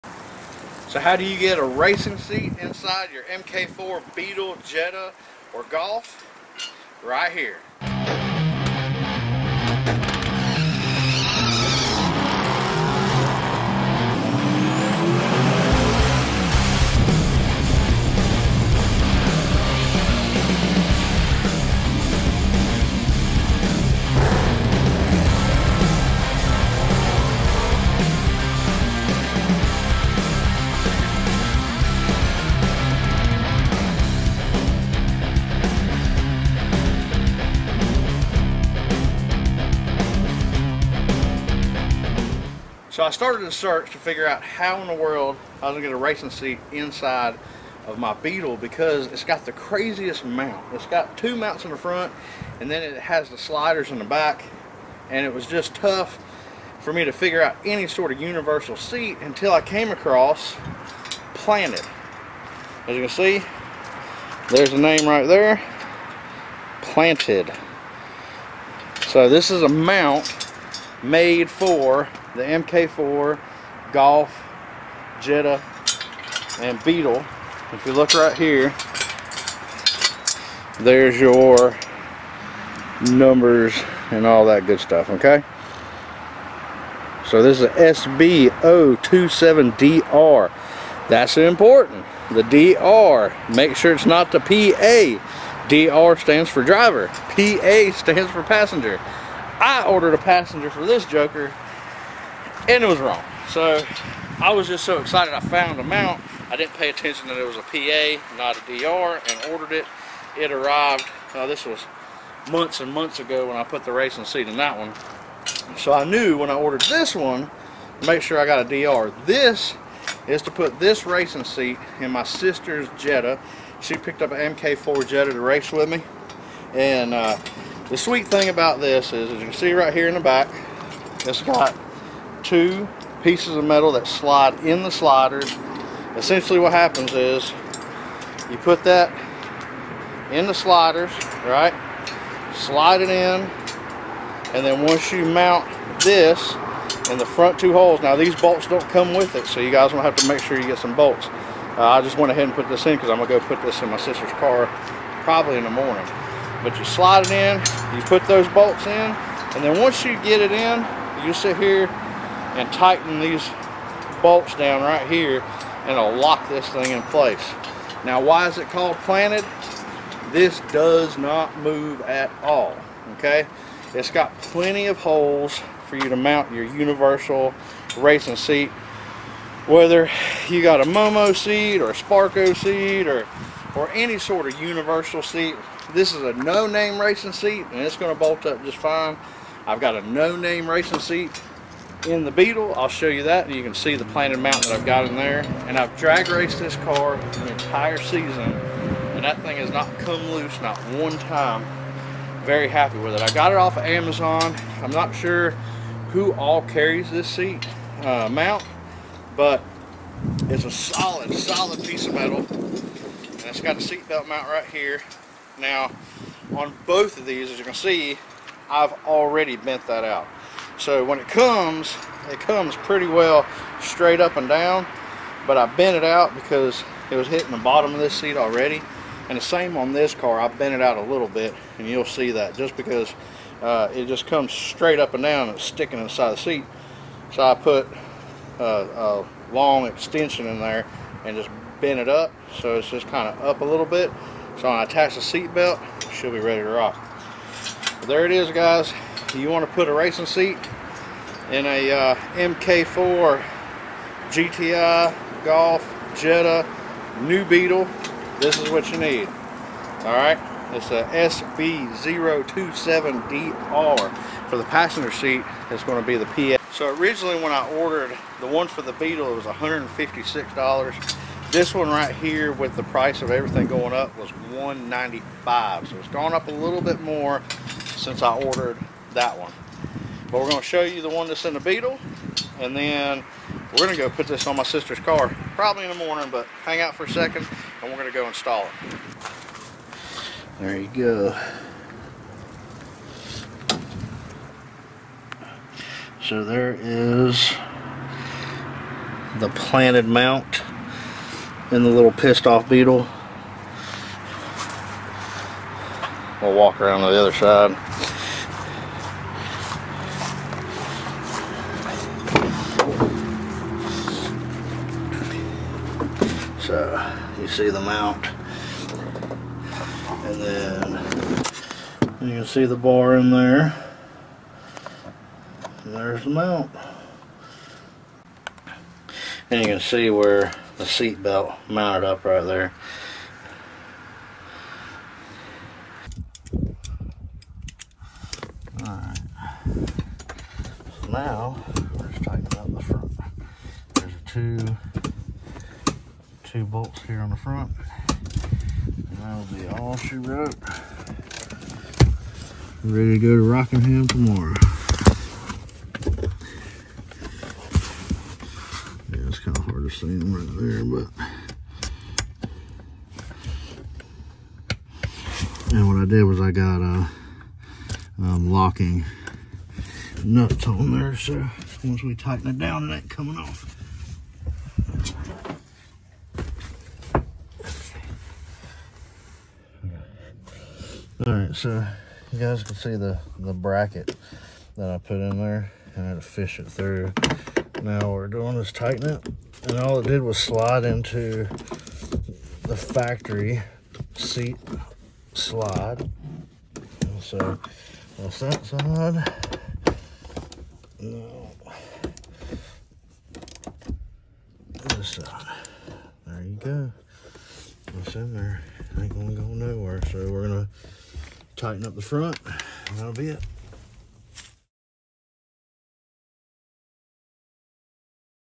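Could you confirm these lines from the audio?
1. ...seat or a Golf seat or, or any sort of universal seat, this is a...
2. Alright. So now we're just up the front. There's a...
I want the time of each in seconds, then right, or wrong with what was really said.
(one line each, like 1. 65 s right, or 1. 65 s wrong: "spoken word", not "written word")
1. 181 s wrong: "Sparco", not "Golf"
2. 338 s right.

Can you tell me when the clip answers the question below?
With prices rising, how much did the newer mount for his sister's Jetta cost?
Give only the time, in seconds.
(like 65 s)
274 s.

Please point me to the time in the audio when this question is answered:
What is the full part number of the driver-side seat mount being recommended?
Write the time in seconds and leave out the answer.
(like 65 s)
87 s.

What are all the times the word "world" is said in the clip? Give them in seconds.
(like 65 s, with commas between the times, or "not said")
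44 s.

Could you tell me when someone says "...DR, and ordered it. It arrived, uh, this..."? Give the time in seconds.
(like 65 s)
108 s.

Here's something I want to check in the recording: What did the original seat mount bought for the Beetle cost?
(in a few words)
$156.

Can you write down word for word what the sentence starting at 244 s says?
So when I attach the seat belt, she'll be ready to rock.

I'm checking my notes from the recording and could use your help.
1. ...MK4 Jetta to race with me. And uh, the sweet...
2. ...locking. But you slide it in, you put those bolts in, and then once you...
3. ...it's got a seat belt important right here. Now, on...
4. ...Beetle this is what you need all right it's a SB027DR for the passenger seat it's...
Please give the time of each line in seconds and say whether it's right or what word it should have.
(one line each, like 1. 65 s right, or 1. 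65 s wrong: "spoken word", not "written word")
1. 124 s right
2. 155 s wrong: "morning", not "locking"
3. 213 s wrong: "mount", not "important"
4. 257 s right.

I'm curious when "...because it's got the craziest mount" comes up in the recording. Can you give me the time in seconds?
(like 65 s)
48 s.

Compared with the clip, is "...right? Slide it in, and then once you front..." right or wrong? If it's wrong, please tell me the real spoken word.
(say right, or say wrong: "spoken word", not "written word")
wrong: "mount", not "front".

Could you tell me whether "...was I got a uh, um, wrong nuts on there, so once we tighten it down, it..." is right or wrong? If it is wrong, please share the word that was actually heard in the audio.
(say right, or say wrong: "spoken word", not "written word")
wrong: "locking", not "wrong".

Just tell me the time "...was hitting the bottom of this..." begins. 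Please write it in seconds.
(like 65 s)
227 s.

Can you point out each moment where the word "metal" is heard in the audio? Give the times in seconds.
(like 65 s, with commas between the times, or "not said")
133 s, 212 s.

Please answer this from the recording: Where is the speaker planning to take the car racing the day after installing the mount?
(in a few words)
Rockingham.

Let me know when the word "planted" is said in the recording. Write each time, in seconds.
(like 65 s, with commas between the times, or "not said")
61 s, 66 s, 168 s, 194 s, 299 s.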